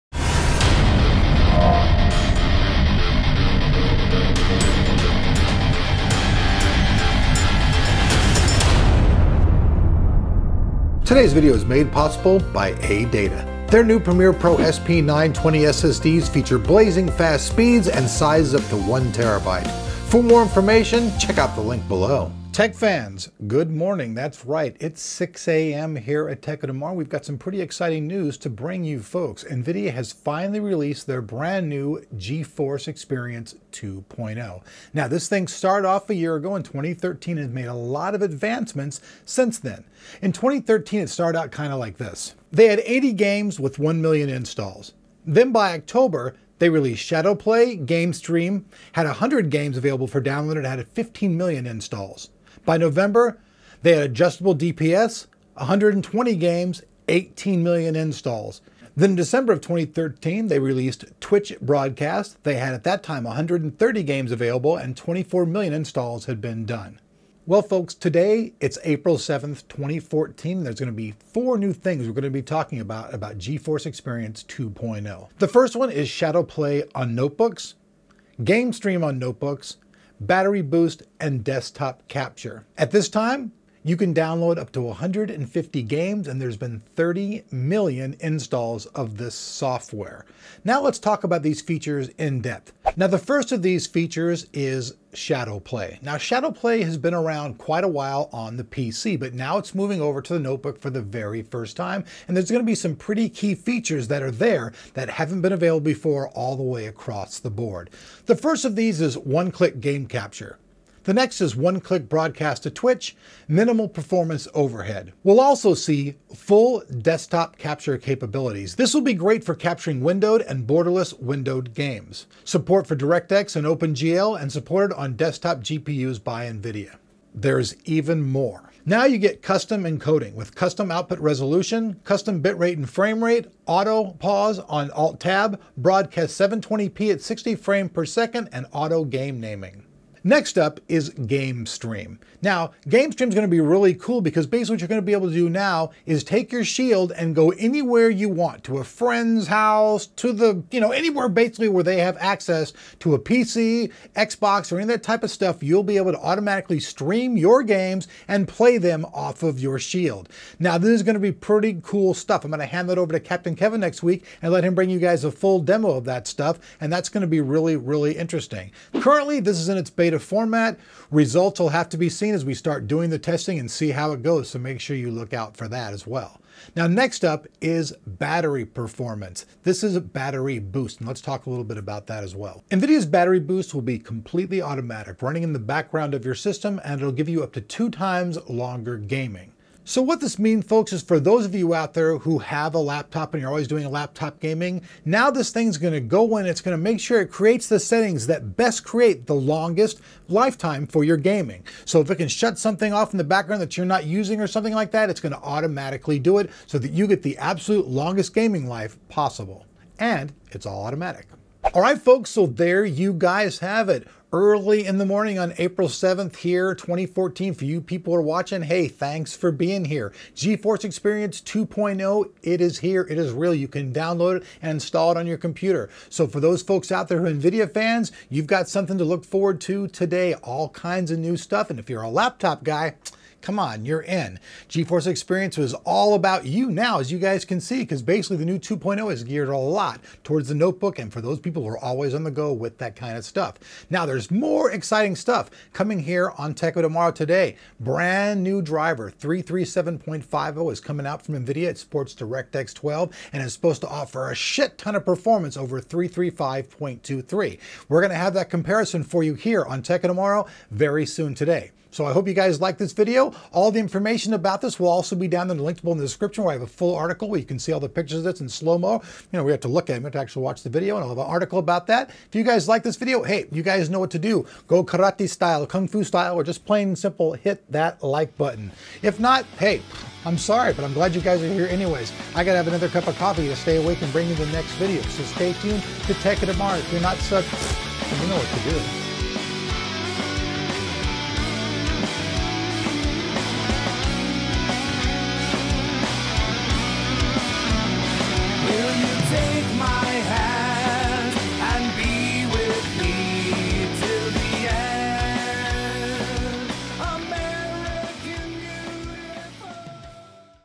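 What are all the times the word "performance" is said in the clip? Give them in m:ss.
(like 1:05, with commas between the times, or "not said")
1:53, 2:58, 4:15.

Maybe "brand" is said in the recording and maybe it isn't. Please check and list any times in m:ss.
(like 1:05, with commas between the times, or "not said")
0:31, 4:07.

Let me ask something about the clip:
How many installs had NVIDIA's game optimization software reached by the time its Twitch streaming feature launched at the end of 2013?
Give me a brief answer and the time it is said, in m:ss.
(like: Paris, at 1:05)
24 million, at 1:04.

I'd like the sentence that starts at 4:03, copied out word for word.
Now, there's more exciting stuff coming here on Tech of Tomorrow today.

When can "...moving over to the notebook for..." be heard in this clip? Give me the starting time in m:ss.
1:39.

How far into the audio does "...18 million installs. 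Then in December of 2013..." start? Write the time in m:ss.
0:57.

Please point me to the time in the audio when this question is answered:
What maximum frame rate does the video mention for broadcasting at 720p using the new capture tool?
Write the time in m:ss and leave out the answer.
2:17.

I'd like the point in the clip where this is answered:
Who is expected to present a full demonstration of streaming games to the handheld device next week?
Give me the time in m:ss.
2:43.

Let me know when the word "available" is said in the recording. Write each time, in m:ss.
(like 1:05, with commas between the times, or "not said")
0:49, 1:04, 1:45.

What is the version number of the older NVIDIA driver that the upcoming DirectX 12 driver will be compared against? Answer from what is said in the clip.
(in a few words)
335.23.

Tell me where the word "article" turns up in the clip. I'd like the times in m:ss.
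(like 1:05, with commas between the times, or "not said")
4:26, 4:31.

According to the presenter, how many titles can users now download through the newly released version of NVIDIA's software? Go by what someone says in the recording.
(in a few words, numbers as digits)
150.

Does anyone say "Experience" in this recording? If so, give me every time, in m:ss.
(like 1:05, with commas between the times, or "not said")
0:32, 1:13, 3:40, 3:55.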